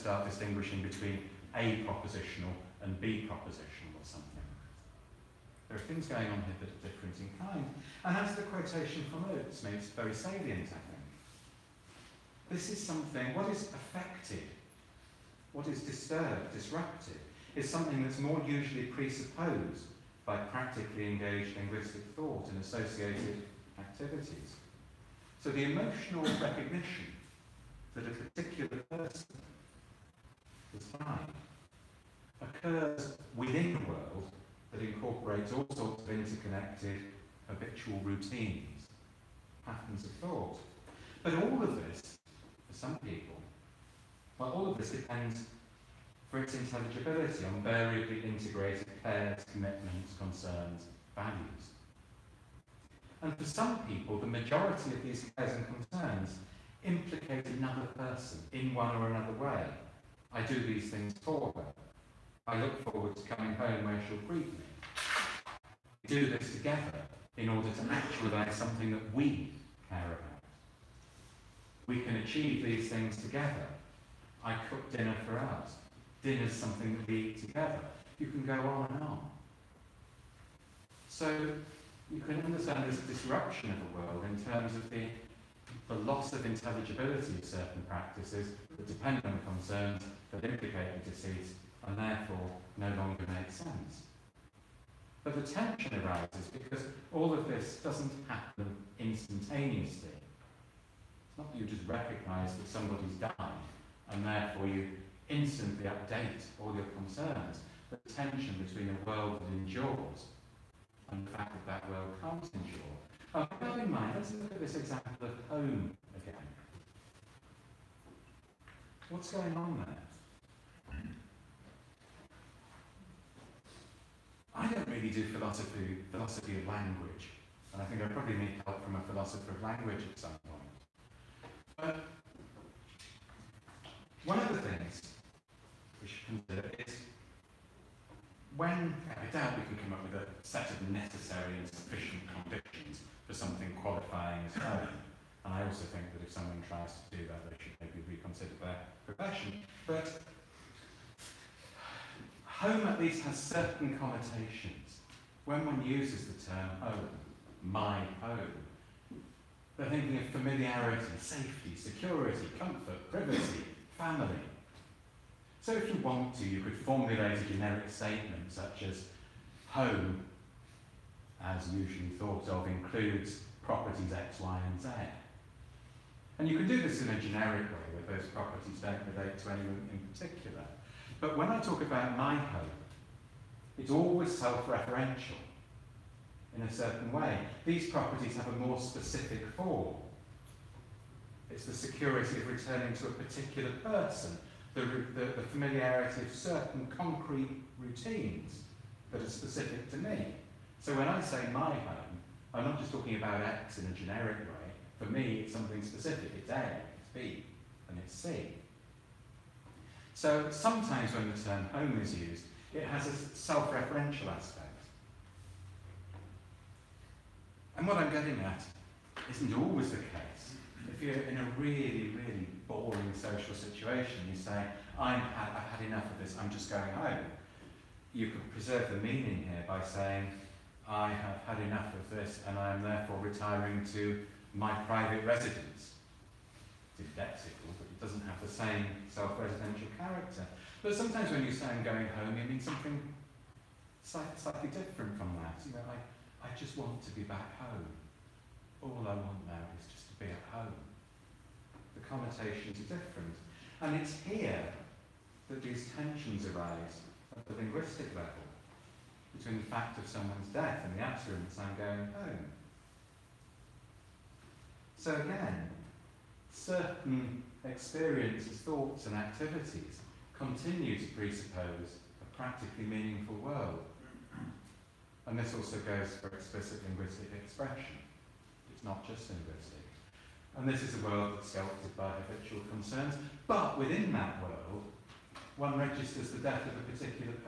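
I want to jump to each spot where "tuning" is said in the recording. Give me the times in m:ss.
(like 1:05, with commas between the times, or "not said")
not said.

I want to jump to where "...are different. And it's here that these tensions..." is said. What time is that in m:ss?
4:12.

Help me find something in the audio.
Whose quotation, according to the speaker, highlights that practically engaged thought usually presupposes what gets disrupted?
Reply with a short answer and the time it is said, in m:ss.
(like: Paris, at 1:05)
Oates, at 0:09.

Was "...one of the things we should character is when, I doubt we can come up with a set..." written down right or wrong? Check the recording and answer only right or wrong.
wrong.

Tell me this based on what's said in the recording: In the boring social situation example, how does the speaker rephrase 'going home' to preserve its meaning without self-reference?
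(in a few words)
Retiring to my private residence.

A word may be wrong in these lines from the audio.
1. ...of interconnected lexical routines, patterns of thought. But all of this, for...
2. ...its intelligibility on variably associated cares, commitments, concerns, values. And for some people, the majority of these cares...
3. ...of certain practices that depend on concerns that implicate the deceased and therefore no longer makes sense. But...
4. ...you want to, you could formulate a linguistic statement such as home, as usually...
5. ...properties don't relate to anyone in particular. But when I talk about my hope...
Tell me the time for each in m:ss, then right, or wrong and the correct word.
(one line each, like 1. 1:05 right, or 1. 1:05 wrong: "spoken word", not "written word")
1. 0:36 wrong: "habitual", not "lexical"
2. 0:46 wrong: "integrated", not "associated"
3. 1:27 right
4. 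2:45 wrong: "generic", not "linguistic"
5. 2:58 right.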